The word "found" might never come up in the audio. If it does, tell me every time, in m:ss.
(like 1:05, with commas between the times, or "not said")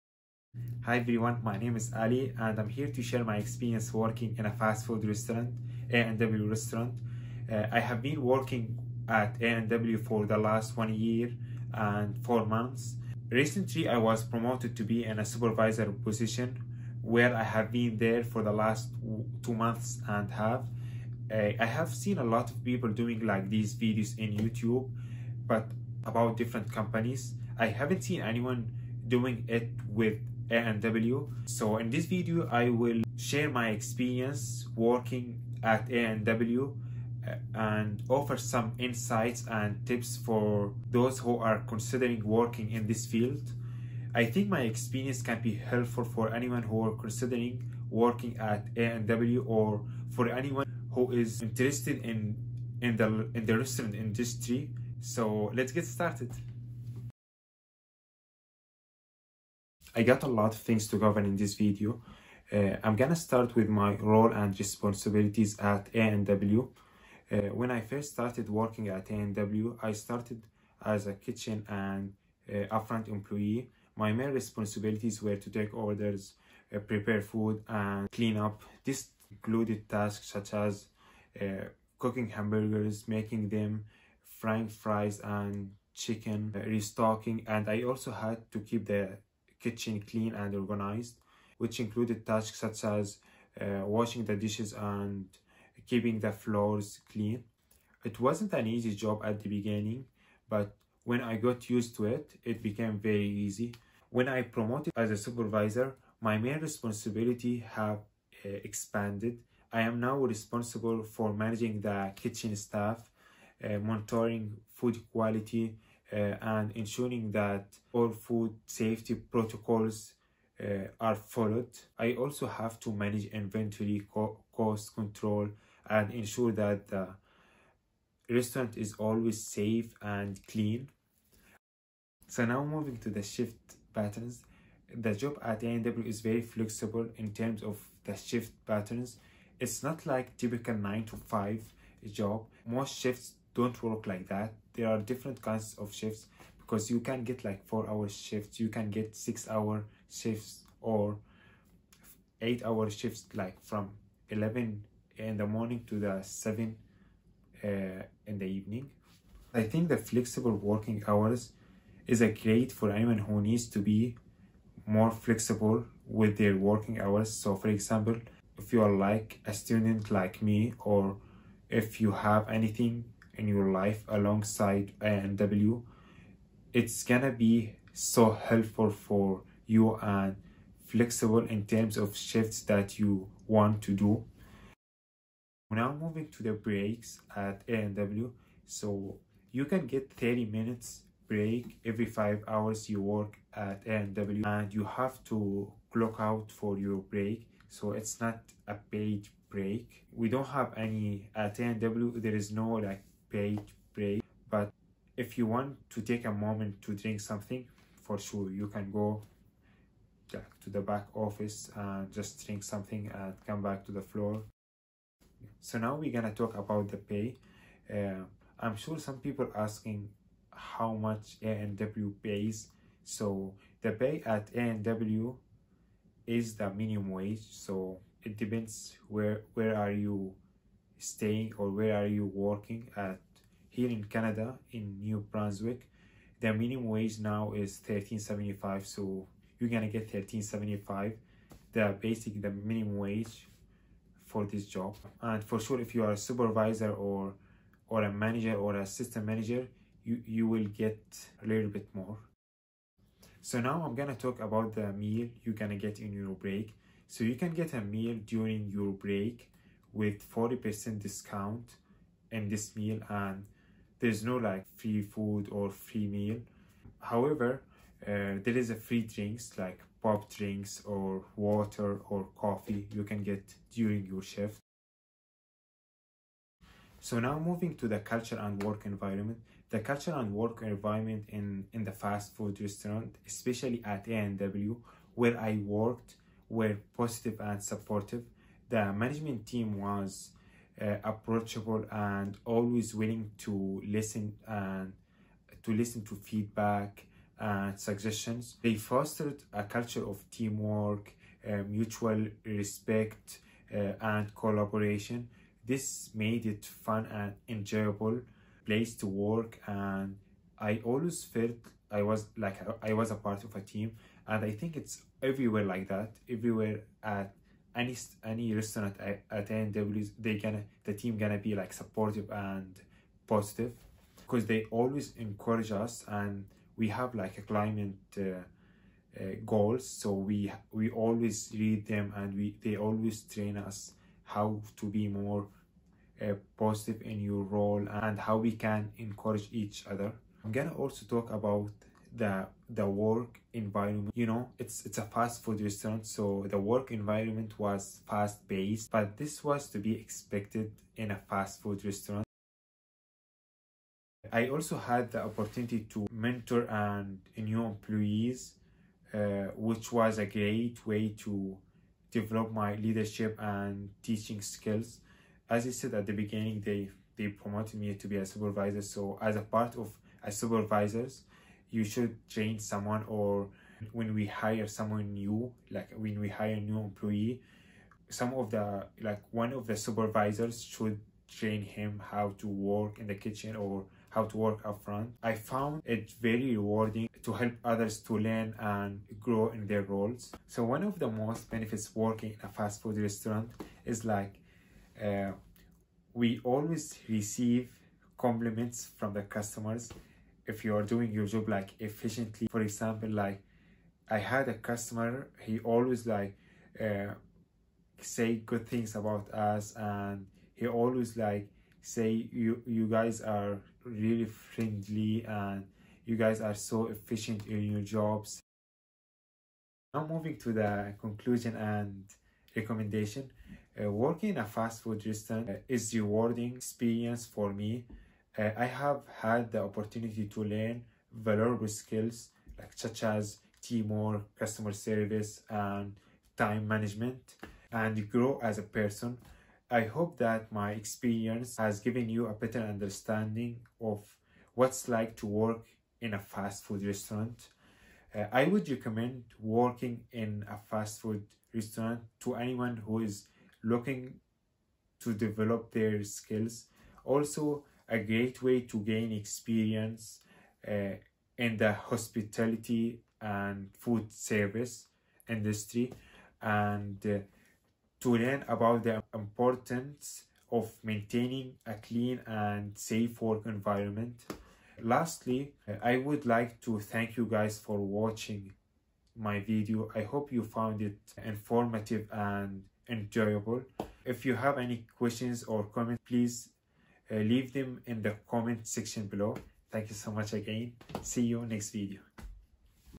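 6:25, 8:00.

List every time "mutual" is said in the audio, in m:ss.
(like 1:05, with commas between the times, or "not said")
5:01.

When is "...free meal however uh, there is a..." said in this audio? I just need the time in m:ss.
4:25.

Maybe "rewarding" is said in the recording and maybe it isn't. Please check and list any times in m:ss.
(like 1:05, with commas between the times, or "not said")
6:26, 7:05.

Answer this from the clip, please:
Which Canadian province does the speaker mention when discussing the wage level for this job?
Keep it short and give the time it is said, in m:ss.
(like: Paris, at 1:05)
New Brunswick, at 3:55.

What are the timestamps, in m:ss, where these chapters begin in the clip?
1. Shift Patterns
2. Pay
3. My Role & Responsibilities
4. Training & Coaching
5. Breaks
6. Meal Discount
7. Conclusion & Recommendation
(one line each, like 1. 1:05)
1. 2:11
2. 3:35
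3. 0:58
4. 5:54
5. 3:05
6. 4:13
7. 6:59.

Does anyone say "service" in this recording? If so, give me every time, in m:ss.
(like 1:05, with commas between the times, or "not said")
7:14, 7:44.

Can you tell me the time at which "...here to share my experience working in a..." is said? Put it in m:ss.
0:02.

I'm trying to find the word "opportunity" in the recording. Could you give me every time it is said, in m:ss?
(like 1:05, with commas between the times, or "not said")
5:55, 7:09.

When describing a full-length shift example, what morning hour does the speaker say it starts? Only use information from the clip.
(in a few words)
11.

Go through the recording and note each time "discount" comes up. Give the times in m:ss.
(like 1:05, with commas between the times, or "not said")
4:21.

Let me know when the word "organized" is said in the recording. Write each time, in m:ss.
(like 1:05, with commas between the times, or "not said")
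1:30.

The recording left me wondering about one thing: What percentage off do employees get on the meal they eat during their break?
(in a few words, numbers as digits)
40%.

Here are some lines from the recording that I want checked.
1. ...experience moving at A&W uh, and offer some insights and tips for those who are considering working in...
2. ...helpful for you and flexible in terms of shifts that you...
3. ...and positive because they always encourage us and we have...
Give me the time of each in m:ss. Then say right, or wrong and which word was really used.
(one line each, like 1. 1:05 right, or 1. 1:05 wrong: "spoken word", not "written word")
1. 0:33 wrong: "working", not "moving"
2. 2:58 right
3. 5:22 right.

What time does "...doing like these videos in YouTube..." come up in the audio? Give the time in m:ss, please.
0:22.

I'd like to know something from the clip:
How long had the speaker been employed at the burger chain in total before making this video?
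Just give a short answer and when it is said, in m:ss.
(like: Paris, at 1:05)
1 year and 4 months, at 0:10.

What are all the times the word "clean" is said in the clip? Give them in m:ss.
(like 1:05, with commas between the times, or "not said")
1:18, 1:30, 1:37, 2:10, 7:51.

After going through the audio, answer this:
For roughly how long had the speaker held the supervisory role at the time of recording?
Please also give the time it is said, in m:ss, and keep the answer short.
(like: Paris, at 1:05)
2 and a half months, at 0:19.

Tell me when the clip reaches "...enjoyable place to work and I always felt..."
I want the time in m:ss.
5:07.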